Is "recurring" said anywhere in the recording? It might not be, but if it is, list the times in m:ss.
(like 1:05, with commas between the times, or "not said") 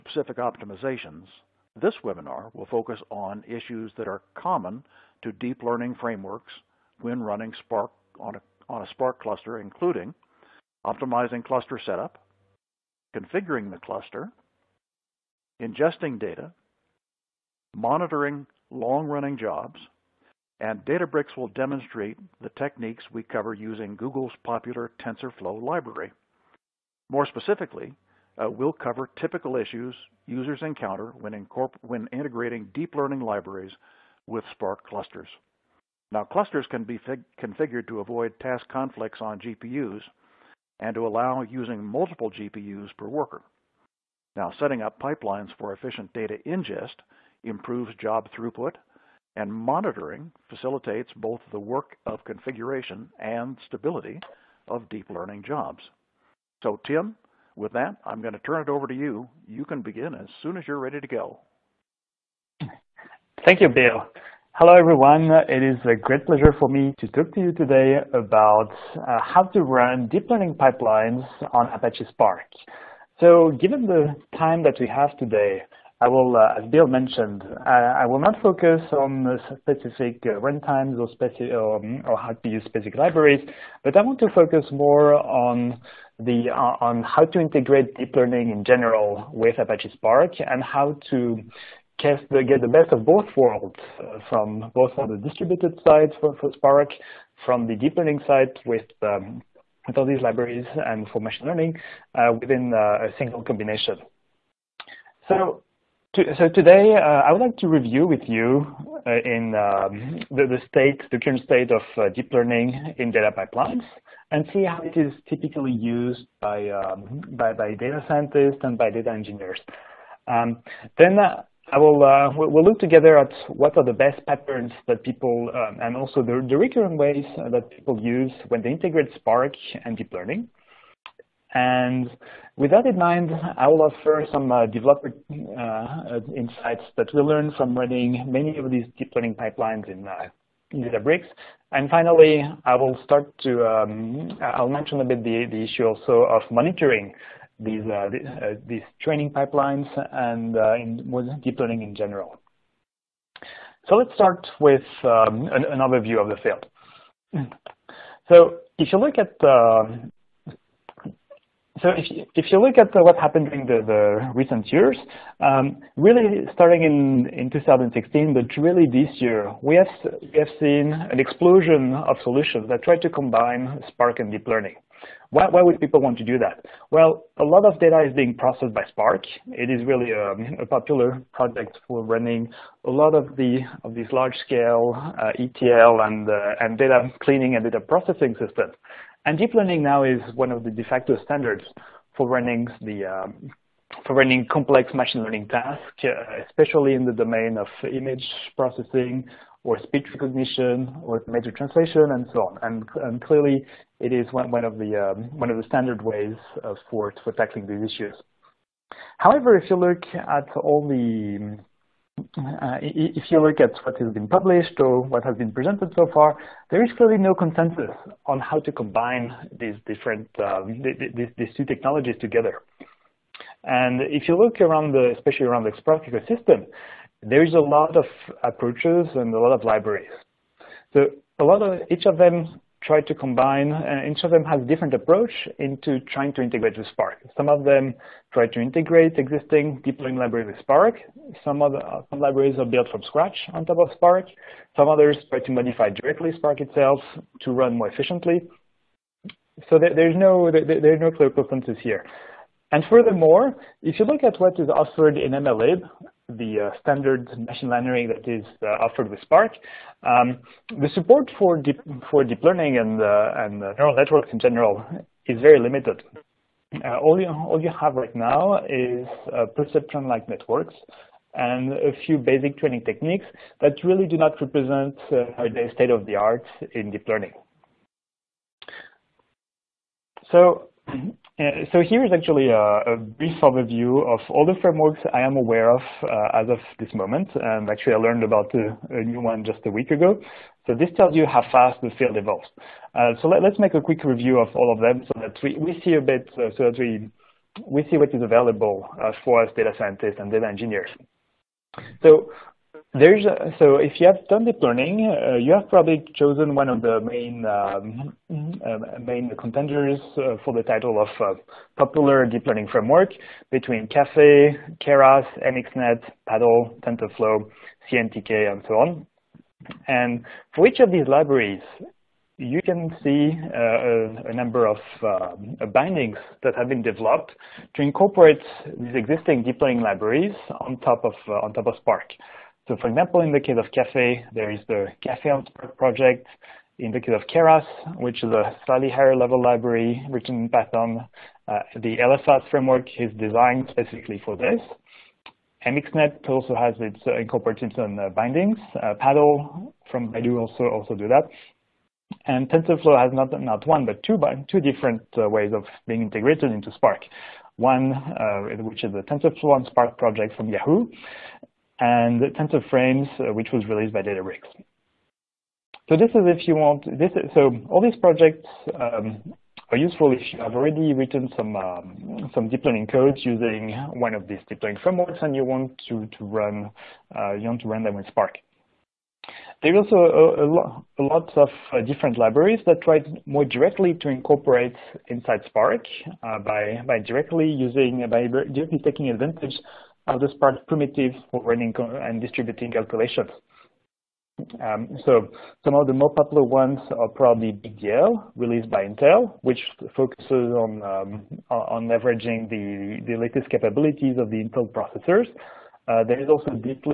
2:06.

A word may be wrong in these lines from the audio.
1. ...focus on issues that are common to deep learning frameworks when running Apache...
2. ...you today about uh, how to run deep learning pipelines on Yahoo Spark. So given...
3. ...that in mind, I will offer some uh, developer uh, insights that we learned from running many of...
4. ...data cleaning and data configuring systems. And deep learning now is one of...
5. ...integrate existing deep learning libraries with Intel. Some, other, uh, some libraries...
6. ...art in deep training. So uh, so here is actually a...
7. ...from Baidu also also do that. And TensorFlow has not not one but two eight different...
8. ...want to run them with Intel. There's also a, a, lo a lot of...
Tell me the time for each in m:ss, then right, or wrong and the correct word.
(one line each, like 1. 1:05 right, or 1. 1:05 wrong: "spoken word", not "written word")
1. 0:02 wrong: "Spark", not "Apache"
2. 1:07 wrong: "Apache", not "Yahoo"
3. 2:12 right
4. 3:06 wrong: "processing", not "configuring"
5. 3:58 wrong: "Spark", not "Intel"
6. 4:36 wrong: "learning", not "training"
7. 5:49 wrong: "two", not "eight"
8. 6:17 wrong: "Spark", not "Intel".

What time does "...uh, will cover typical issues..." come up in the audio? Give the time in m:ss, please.
0:28.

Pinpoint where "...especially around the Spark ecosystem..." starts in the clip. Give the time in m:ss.
3:45.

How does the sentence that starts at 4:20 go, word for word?
Um, the support for deep, for deep learning and, uh, and uh, neural networks in general is very limited.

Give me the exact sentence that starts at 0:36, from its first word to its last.
Now, clusters can be configured to avoid task conflicts on GPUs and to allow using multiple GPUs per worker.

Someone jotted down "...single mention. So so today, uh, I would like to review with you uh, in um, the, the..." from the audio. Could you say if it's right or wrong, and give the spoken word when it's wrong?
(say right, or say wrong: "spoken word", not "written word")
wrong: "combination", not "mention".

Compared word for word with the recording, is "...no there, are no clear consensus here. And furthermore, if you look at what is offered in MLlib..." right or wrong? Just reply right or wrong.
right.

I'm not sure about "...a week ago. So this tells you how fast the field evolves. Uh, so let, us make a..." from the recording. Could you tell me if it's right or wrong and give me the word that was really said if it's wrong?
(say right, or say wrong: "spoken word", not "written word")
right.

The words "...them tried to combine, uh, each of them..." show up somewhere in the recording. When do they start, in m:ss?
3:52.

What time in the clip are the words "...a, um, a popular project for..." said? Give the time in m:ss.
3:00.